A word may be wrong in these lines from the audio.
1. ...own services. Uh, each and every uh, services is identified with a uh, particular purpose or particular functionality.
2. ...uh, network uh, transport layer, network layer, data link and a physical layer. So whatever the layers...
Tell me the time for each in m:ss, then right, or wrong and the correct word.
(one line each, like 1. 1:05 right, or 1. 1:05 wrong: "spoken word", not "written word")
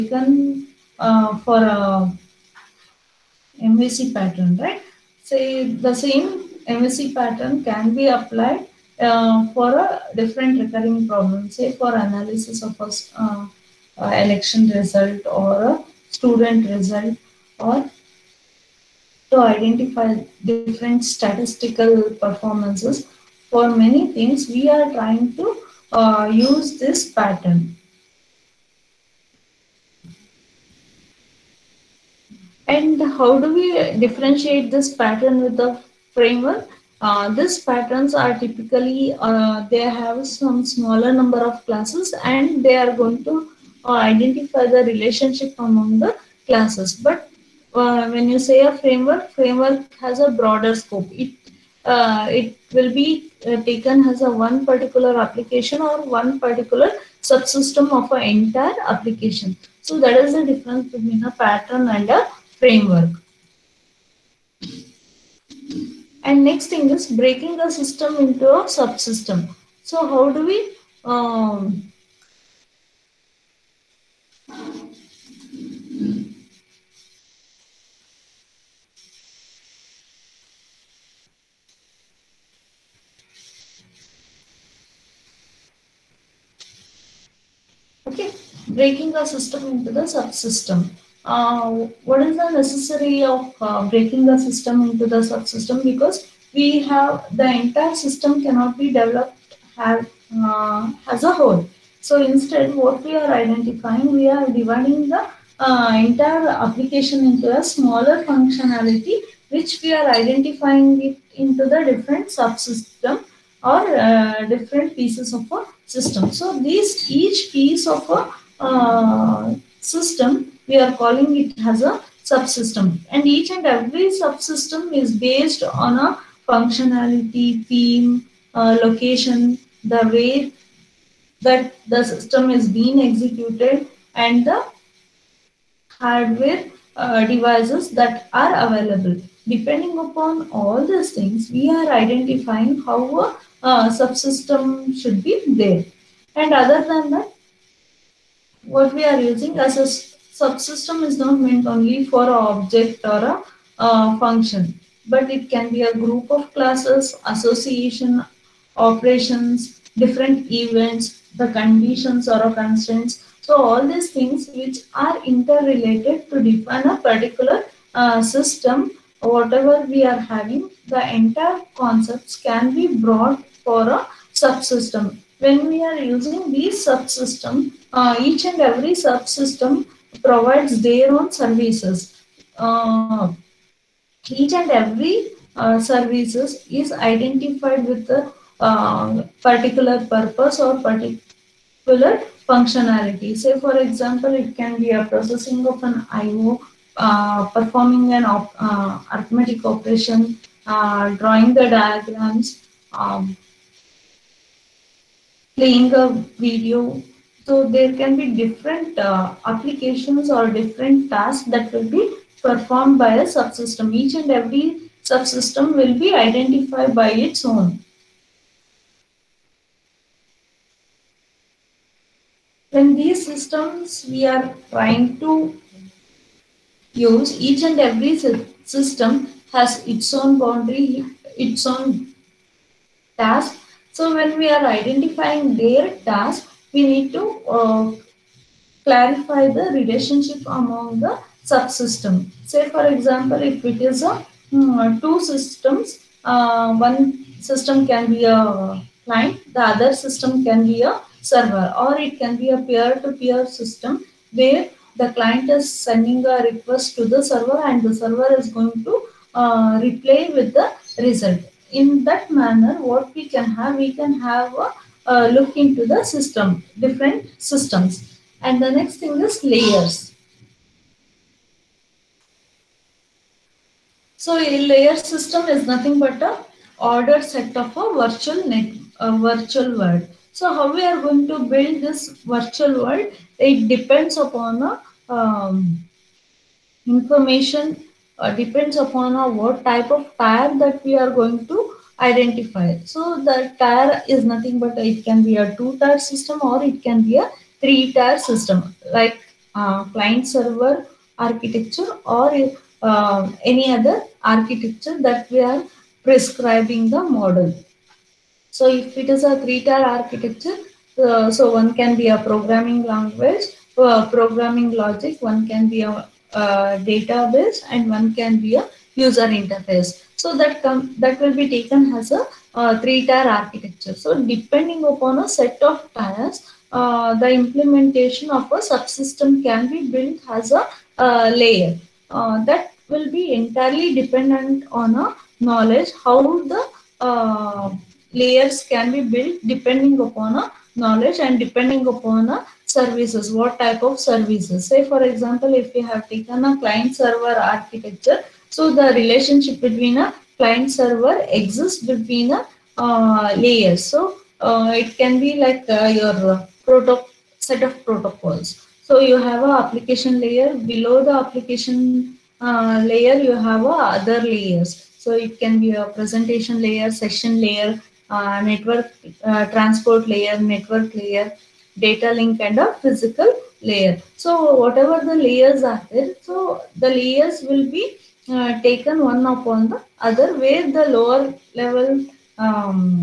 1. 3:01 right
2. 6:08 right.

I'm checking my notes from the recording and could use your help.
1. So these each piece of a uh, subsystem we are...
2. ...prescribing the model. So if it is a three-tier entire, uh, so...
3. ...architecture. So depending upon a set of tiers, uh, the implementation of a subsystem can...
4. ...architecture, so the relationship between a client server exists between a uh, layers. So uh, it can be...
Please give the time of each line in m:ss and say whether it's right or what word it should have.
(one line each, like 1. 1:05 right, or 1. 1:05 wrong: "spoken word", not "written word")
1. 1:56 wrong: "system", not "subsystem"
2. 5:06 wrong: "architecture", not "entire"
3. 5:23 right
4. 5:47 right.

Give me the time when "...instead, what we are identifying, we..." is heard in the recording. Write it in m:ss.
1:42.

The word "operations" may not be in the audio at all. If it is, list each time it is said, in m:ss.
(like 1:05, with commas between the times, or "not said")
2:38, 3:19.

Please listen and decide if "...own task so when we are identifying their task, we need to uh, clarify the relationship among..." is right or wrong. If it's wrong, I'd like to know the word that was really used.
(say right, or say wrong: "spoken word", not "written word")
right.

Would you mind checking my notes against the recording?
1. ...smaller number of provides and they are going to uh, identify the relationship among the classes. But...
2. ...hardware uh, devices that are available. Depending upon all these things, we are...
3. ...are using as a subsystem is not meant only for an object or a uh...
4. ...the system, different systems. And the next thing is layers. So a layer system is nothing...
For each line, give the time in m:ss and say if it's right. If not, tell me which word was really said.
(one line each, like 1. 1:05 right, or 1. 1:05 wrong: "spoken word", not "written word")
1. 0:40 wrong: "classes", not "provides"
2. 2:15 right
3. 2:29 right
4. 4:25 right.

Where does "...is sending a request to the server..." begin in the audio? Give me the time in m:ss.
4:15.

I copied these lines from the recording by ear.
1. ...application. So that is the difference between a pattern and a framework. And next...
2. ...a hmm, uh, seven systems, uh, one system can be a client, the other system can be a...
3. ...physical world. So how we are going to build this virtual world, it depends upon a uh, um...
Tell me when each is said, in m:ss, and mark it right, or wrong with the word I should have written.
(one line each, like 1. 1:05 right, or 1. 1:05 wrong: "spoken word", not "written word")
1. 0:58 right
2. 4:04 wrong: "two", not "seven"
3. 4:39 wrong: "virtual", not "physical".